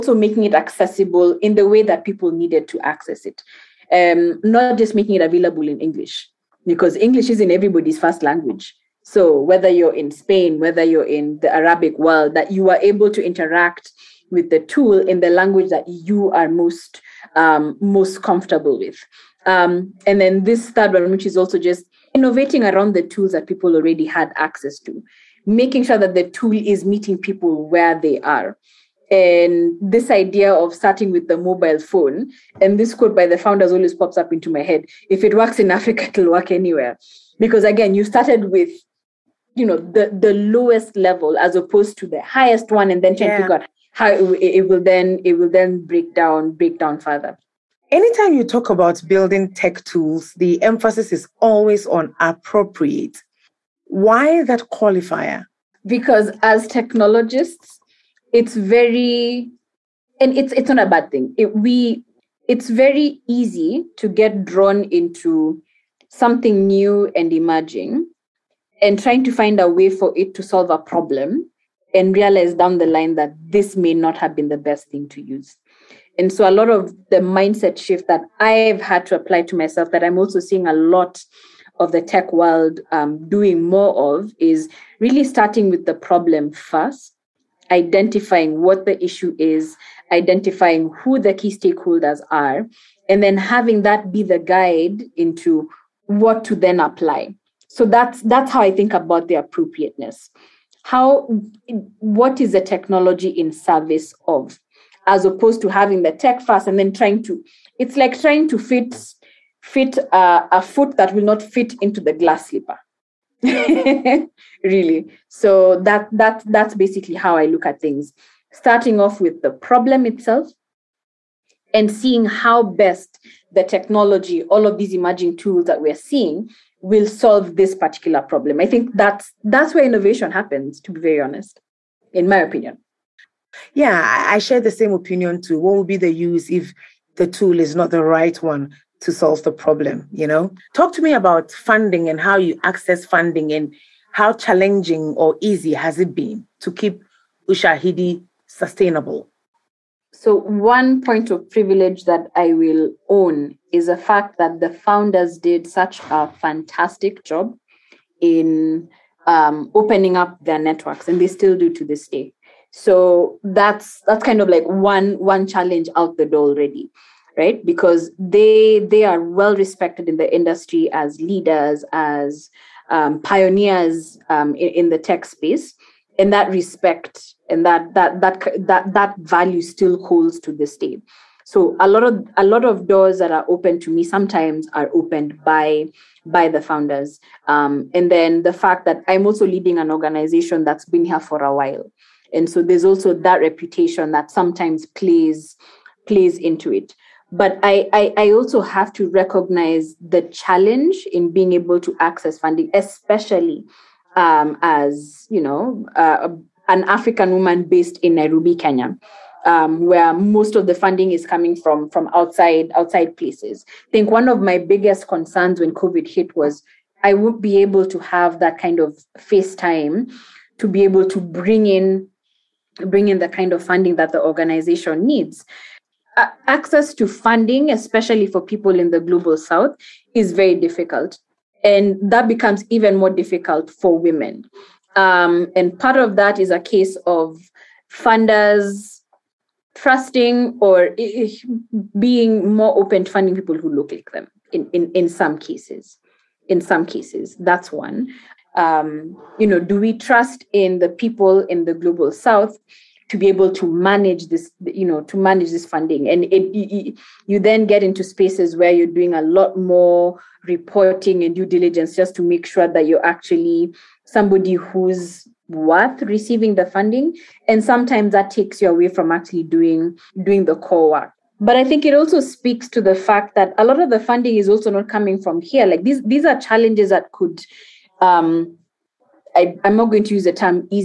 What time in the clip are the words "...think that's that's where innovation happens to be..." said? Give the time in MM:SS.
02:08.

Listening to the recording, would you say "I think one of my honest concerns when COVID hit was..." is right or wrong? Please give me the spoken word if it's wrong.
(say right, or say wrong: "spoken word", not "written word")
wrong: "biggest", not "honest".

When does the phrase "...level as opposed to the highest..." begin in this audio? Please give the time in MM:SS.
00:40.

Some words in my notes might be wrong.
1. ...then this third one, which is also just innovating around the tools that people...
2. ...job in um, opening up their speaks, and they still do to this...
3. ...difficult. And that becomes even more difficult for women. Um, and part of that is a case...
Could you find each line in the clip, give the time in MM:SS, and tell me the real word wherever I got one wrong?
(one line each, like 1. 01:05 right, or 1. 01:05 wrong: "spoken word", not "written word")
1. 00:20 right
2. 02:37 wrong: "networks", not "speaks"
3. 03:50 right.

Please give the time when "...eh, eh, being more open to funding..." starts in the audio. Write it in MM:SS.
04:00.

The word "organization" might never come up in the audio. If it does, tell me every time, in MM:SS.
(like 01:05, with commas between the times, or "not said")
03:09, 03:44.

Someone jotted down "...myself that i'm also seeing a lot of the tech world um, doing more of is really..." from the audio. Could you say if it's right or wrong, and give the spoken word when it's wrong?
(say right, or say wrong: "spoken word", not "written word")
right.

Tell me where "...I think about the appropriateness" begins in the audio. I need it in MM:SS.
01:38.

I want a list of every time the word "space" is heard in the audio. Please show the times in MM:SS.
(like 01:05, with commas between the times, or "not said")
02:55, 04:18.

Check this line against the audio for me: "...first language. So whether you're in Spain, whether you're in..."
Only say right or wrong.
right.